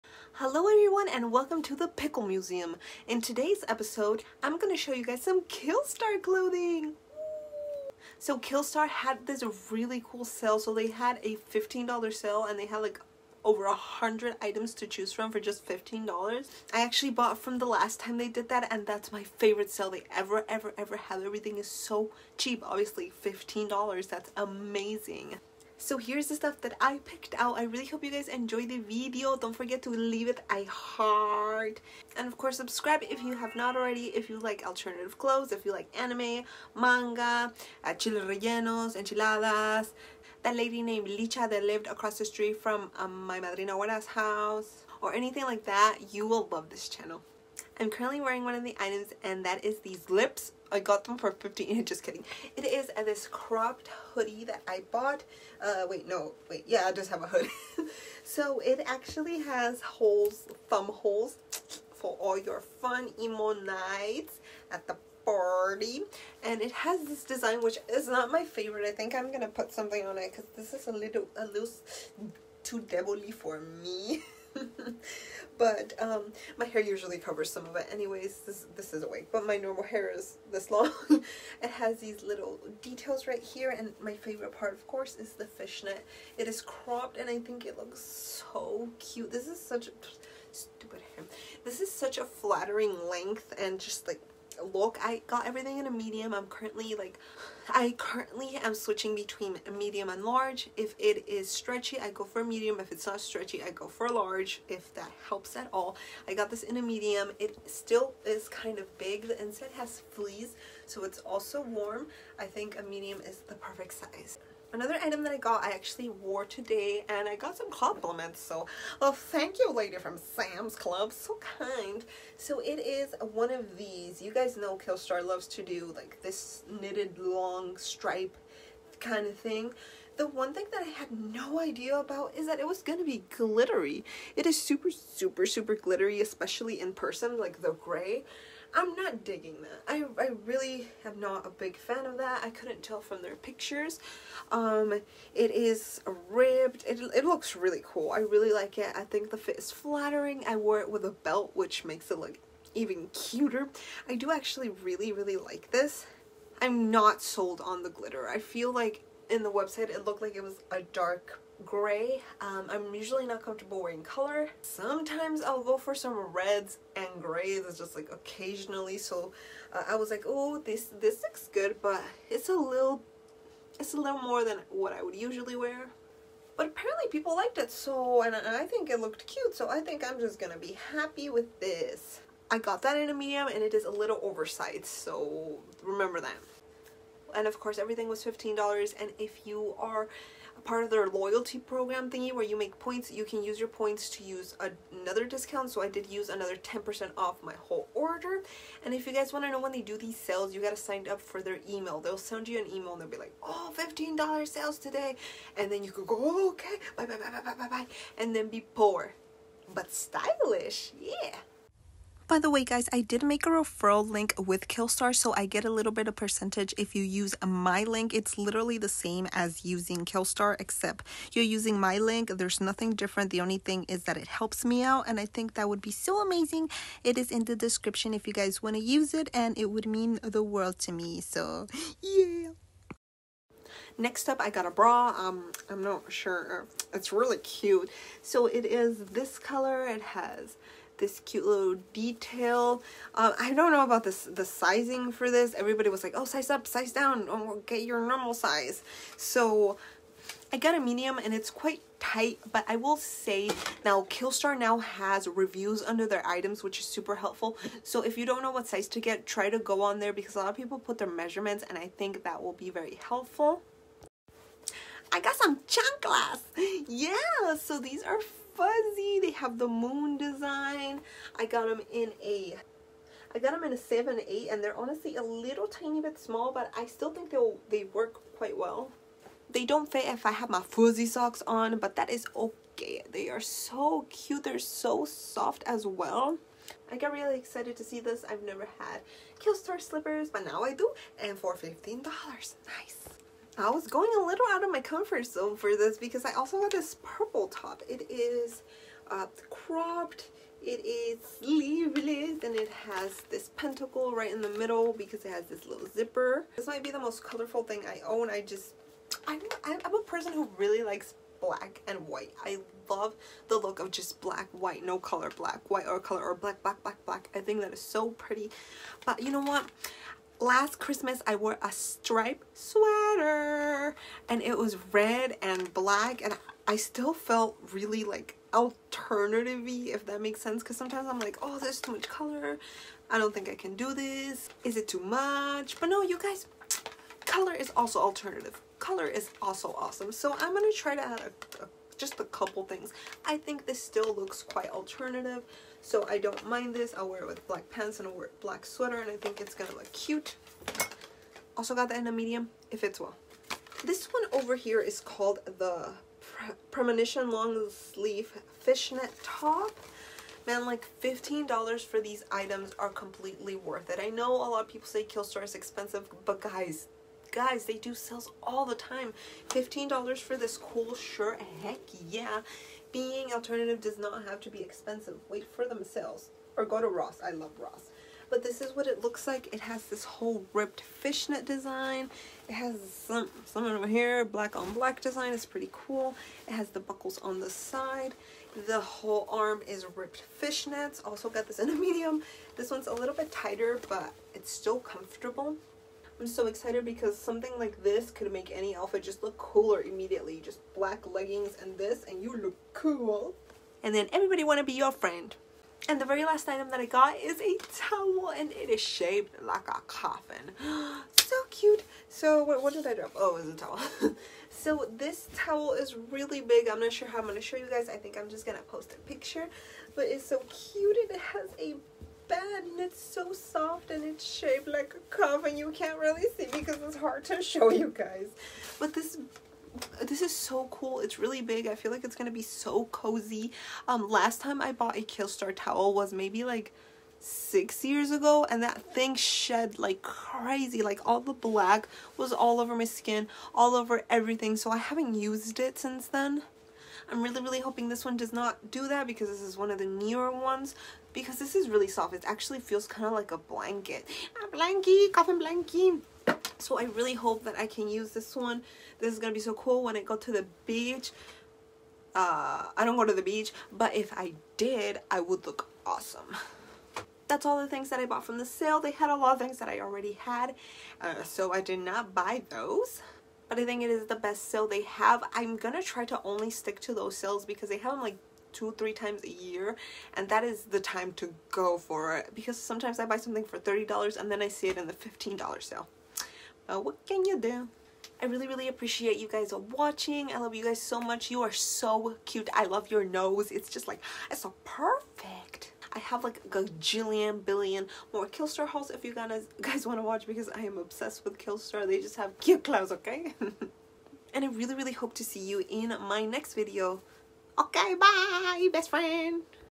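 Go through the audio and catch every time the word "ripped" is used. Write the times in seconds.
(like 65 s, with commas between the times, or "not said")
380 s, 389 s.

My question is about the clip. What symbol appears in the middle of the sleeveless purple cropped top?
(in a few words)
Pentacle.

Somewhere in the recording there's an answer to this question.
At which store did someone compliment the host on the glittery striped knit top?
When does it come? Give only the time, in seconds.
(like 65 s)
120 s.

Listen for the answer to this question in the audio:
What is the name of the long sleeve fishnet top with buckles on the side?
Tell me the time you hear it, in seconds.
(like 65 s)
356 s.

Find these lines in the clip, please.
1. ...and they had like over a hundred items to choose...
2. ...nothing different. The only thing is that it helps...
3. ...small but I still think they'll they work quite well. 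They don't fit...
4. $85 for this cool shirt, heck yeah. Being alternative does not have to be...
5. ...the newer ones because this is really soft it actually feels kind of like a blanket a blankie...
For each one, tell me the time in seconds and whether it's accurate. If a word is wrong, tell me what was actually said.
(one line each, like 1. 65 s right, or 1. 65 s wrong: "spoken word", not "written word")
1. 12 s right
2. 222 s right
3. 276 s right
4. 369 s wrong: "15", not "85"
5. 449 s right.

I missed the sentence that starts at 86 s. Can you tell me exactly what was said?
It is cropped and I think it looks so cute.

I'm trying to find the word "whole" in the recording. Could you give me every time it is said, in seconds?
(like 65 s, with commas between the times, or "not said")
197 s, 380 s, 388 s.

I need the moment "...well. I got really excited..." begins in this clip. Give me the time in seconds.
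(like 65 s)
285 s.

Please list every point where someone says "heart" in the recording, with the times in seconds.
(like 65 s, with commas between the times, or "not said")
30 s.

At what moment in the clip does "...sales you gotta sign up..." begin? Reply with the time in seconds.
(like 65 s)
200 s.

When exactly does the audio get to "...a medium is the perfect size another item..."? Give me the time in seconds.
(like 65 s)
112 s.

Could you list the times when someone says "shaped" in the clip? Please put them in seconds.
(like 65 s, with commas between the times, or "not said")
408 s, 424 s.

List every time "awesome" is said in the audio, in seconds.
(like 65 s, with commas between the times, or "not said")
339 s, 465 s.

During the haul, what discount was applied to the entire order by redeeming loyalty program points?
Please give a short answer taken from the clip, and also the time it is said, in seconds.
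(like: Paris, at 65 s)
10% off, at 196 s.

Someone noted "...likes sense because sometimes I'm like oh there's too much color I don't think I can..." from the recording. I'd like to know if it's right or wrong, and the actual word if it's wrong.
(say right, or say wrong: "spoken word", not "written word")
wrong: "makes", not "likes".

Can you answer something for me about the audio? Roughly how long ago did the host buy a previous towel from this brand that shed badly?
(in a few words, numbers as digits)
6 years ago.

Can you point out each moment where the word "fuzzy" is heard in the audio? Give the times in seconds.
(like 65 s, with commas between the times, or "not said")
268 s, 280 s.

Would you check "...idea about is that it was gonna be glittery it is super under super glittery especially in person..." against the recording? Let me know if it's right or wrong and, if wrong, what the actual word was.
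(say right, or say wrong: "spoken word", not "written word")
wrong: "super", not "under".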